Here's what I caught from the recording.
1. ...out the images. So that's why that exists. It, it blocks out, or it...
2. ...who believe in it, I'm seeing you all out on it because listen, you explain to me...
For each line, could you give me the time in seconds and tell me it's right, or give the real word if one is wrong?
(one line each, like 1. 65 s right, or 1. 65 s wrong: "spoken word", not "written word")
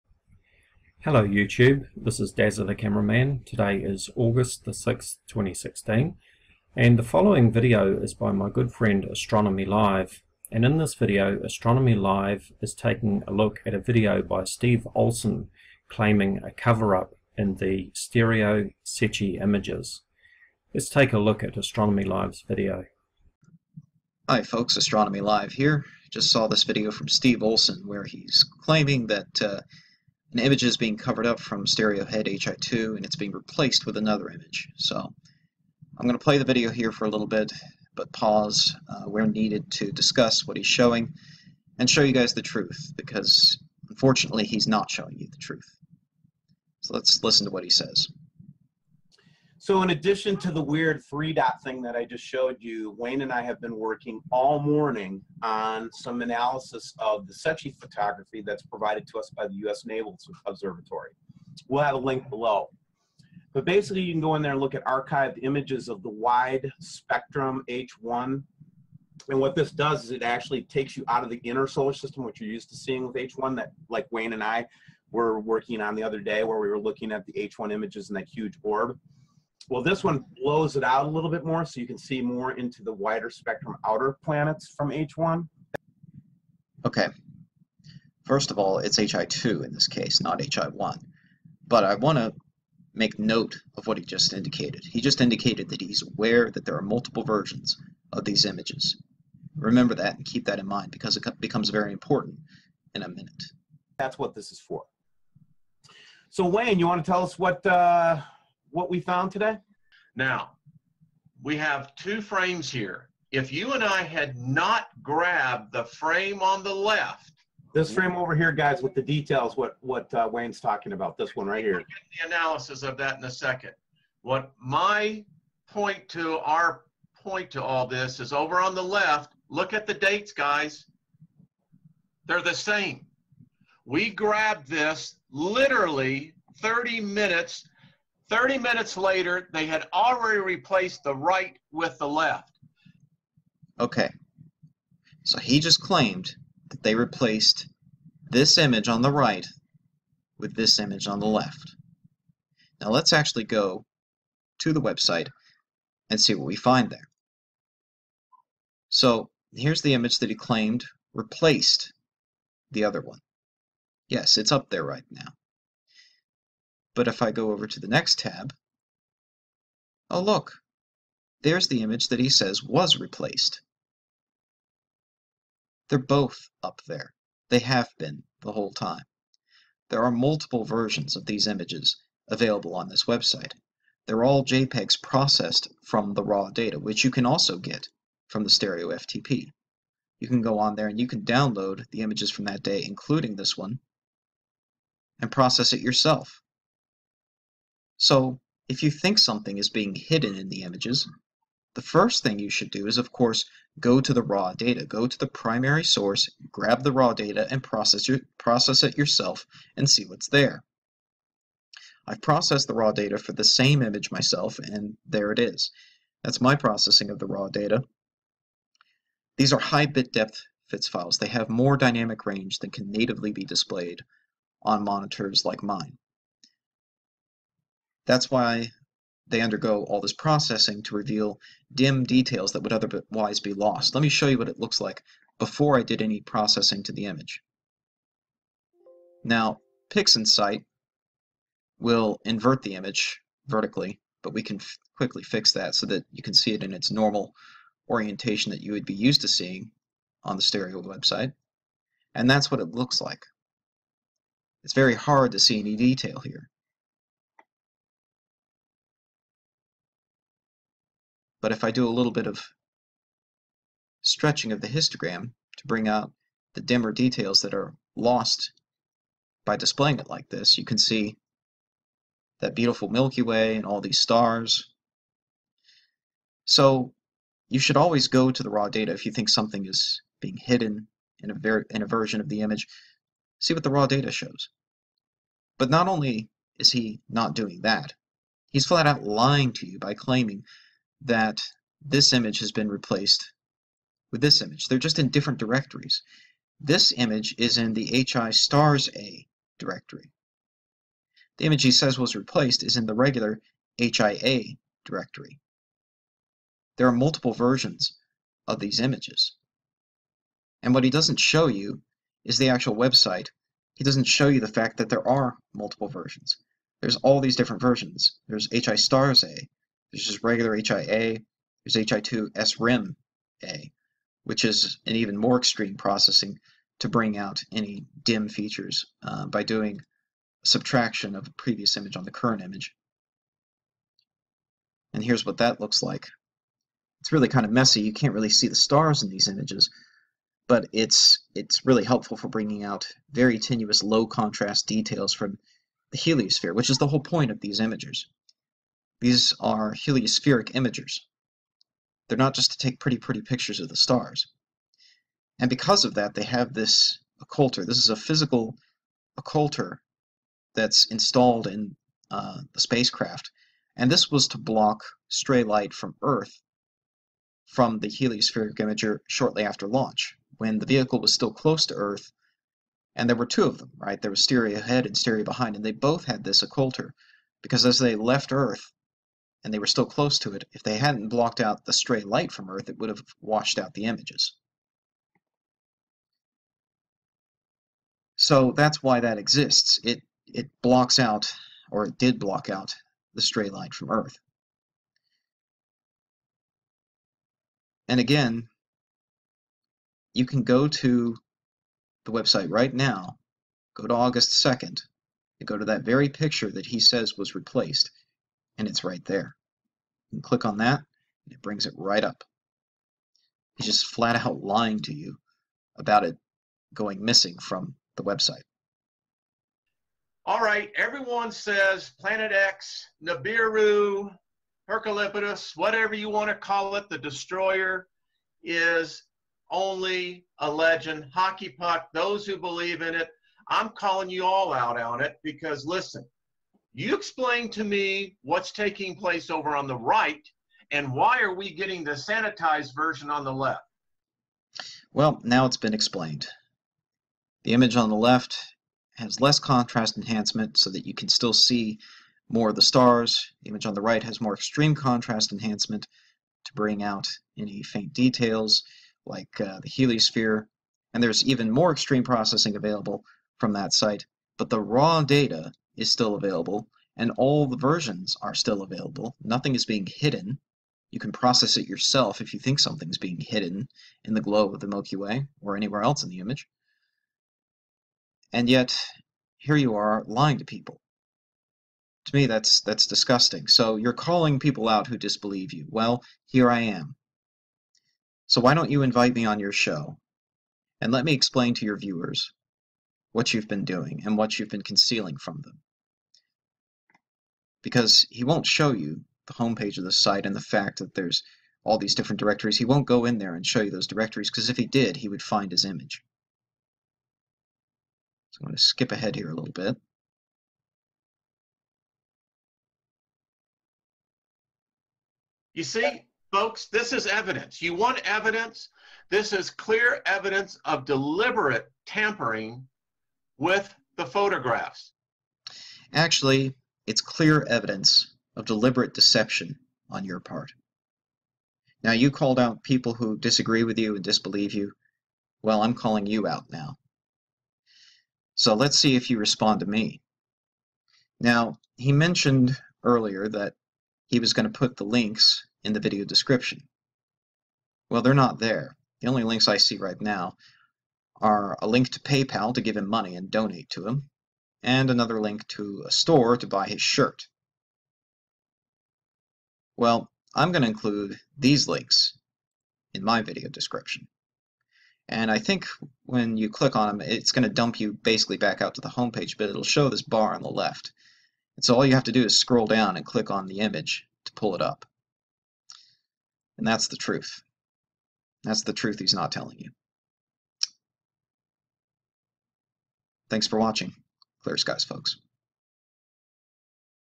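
1. 383 s right
2. 432 s wrong: "calling", not "seeing".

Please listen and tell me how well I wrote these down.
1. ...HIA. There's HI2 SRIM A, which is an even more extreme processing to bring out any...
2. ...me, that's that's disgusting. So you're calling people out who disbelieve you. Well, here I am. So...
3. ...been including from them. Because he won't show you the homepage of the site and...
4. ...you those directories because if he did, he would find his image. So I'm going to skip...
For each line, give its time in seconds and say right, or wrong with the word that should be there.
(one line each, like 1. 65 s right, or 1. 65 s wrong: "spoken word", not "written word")
1. 320 s right
2. 482 s right
3. 494 s wrong: "concealing", not "including"
4. 503 s right.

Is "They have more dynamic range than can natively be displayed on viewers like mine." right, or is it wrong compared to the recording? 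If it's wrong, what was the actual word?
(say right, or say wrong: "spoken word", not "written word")
wrong: "monitors", not "viewers".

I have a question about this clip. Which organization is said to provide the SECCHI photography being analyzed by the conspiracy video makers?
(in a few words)
U.S. Naval Observatory.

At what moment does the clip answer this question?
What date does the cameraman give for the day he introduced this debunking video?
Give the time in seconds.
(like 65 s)
4 s.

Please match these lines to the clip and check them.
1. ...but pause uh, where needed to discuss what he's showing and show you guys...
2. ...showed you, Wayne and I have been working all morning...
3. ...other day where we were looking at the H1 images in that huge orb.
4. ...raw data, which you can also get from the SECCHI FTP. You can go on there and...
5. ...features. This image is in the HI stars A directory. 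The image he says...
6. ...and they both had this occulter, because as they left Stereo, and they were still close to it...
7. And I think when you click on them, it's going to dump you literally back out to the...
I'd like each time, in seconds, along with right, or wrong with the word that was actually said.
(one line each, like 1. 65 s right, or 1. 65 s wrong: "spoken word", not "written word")
1. 37 s right
2. 52 s right
3. 76 s right
4. 186 s wrong: "Stereo", not "SECCHI"
5. 295 s wrong: "directories", not "features"
6. 375 s wrong: "Earth", not "Stereo"
7. 565 s wrong: "basically", not "literally".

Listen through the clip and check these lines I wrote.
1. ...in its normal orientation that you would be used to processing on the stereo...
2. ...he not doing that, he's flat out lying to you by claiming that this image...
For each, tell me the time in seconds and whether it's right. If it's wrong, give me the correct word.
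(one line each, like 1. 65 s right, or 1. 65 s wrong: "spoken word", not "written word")
1. 246 s wrong: "seeing", not "processing"
2. 286 s right.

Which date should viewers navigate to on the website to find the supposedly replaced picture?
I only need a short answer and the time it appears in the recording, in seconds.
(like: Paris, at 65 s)
August 2nd, at 403 s.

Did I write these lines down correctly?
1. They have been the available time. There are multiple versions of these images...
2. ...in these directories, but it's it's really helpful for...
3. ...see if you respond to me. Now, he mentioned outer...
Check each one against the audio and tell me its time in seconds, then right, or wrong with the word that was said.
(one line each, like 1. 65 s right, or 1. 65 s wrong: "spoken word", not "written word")
1. 177 s wrong: "whole", not "available"
2. 339 s wrong: "images", not "directories"
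3. 538 s wrong: "earlier", not "outer".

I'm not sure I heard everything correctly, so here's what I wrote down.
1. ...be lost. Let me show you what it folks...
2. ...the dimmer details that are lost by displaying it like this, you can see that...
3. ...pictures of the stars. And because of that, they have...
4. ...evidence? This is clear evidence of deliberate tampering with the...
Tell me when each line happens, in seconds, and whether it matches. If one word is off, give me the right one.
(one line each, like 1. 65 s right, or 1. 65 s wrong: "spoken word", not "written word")
1. 233 s wrong: "looks", not "folks"
2. 266 s right
3. 353 s right
4. 518 s right.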